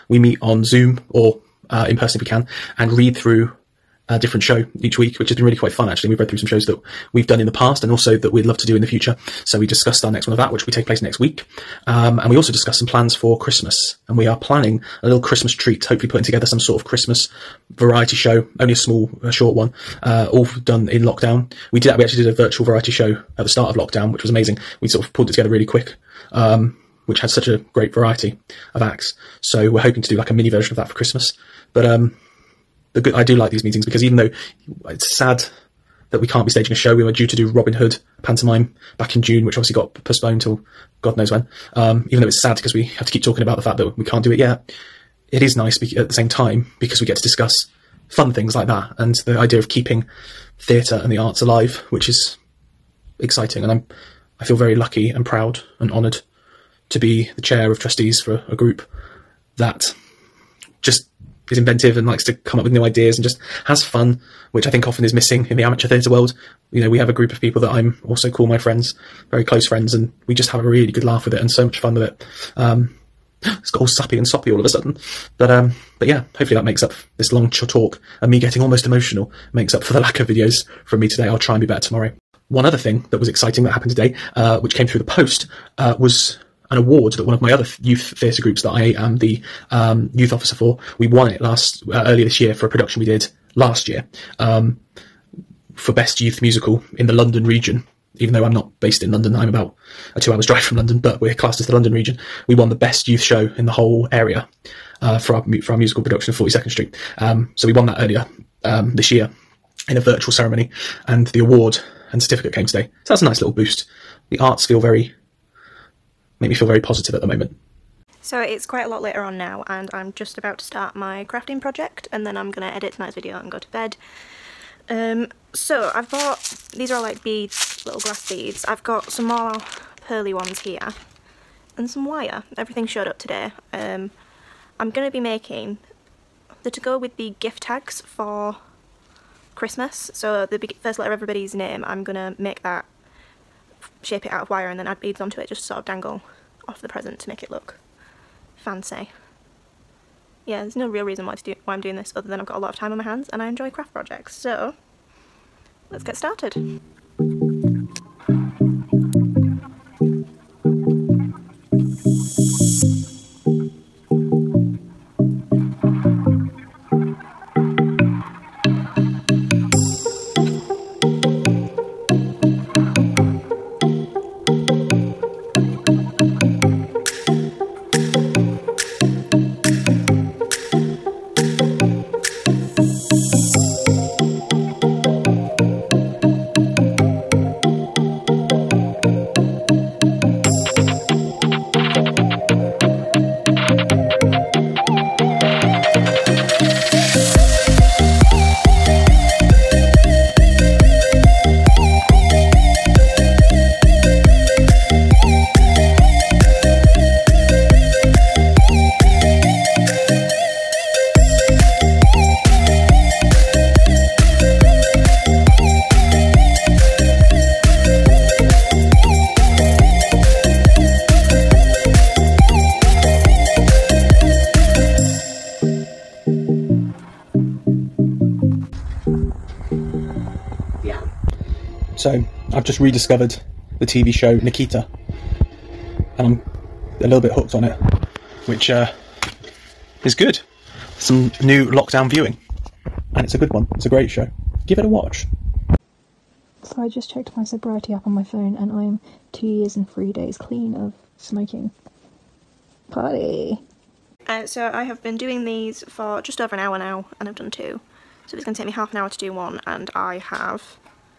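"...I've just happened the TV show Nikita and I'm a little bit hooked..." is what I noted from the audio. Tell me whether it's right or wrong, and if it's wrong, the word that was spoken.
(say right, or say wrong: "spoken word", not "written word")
wrong: "rediscovered", not "happened".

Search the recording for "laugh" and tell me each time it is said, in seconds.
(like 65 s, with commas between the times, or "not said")
71 s.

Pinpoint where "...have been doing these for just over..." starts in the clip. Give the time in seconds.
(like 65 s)
254 s.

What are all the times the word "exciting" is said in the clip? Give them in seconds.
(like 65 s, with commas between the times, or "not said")
53 s, 83 s.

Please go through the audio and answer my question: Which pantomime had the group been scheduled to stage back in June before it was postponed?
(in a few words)
Robin Hood.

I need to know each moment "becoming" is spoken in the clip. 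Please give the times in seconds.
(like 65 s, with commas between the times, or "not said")
not said.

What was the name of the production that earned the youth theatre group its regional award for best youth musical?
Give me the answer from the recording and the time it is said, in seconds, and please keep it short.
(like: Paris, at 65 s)
Forty Second Street, at 106 s.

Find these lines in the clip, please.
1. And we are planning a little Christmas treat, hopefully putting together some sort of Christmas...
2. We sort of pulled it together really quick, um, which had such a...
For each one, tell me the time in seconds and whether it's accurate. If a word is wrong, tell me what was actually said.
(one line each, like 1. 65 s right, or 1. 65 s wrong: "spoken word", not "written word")
1. 14 s right
2. 24 s right.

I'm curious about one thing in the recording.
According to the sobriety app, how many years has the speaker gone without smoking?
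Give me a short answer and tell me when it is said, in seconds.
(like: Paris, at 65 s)
2 years, at 249 s.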